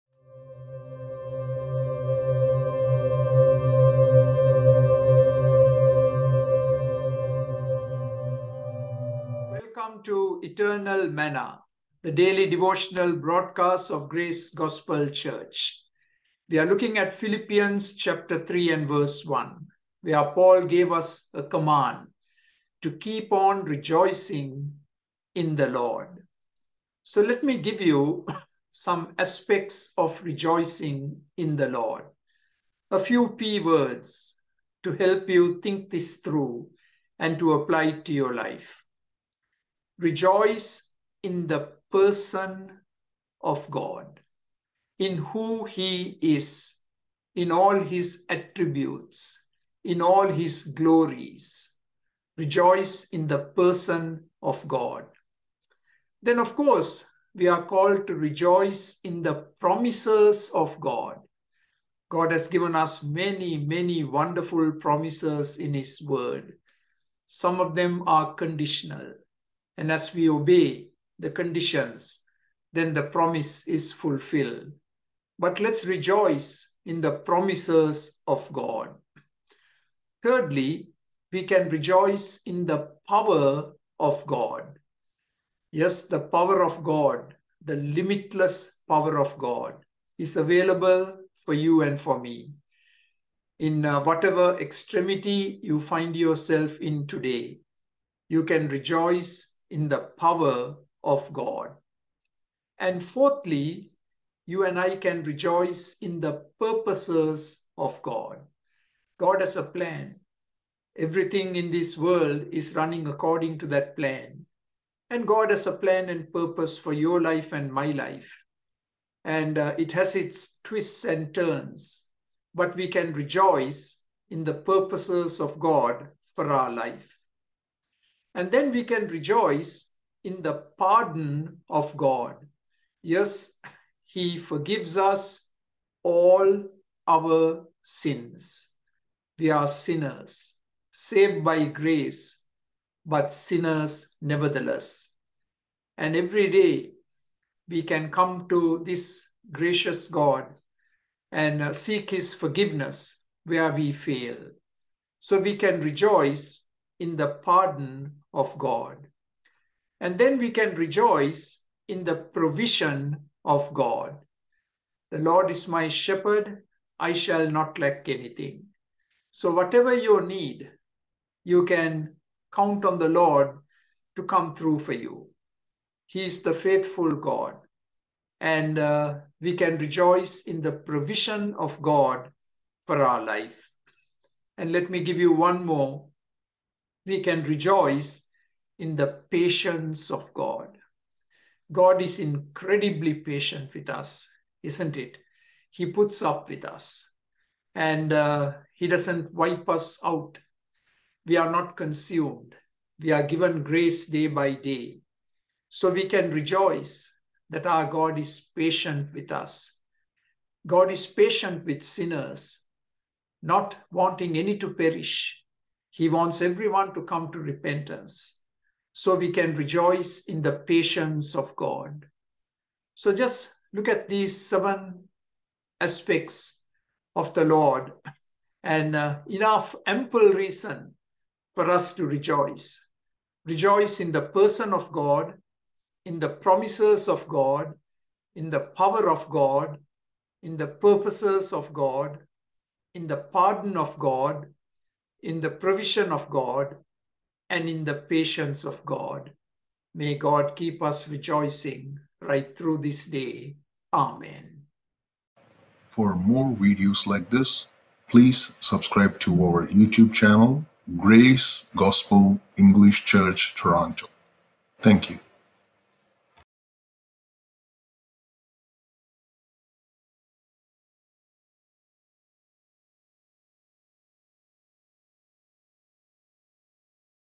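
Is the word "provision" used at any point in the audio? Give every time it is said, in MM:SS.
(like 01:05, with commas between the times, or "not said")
02:42, 03:00, 04:05.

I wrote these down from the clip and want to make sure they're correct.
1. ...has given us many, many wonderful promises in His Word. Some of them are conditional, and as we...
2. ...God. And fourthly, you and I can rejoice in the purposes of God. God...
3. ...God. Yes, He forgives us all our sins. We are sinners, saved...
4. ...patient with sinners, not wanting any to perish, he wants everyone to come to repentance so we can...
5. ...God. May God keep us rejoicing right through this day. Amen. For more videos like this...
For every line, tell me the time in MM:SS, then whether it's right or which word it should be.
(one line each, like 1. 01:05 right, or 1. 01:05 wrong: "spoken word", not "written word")
1. 01:02 right
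2. 01:41 right
3. 02:11 right
4. 03:31 right
5. 04:08 right.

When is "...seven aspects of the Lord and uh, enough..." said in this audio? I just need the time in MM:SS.
03:44.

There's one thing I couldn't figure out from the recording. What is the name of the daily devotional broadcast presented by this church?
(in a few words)
Eternal Manna.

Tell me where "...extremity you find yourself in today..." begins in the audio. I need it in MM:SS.
01:34.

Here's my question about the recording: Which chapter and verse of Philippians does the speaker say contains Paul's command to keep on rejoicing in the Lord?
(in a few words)
Chapter 3, verse 1.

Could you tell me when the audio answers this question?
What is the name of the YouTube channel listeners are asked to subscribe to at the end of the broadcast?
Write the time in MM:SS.
04:20.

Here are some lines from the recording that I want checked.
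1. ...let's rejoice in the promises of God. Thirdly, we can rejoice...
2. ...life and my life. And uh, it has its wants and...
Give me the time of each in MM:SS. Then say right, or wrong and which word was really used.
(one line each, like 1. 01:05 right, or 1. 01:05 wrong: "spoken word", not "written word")
1. 01:15 right
2. 01:57 wrong: "twists", not "wants".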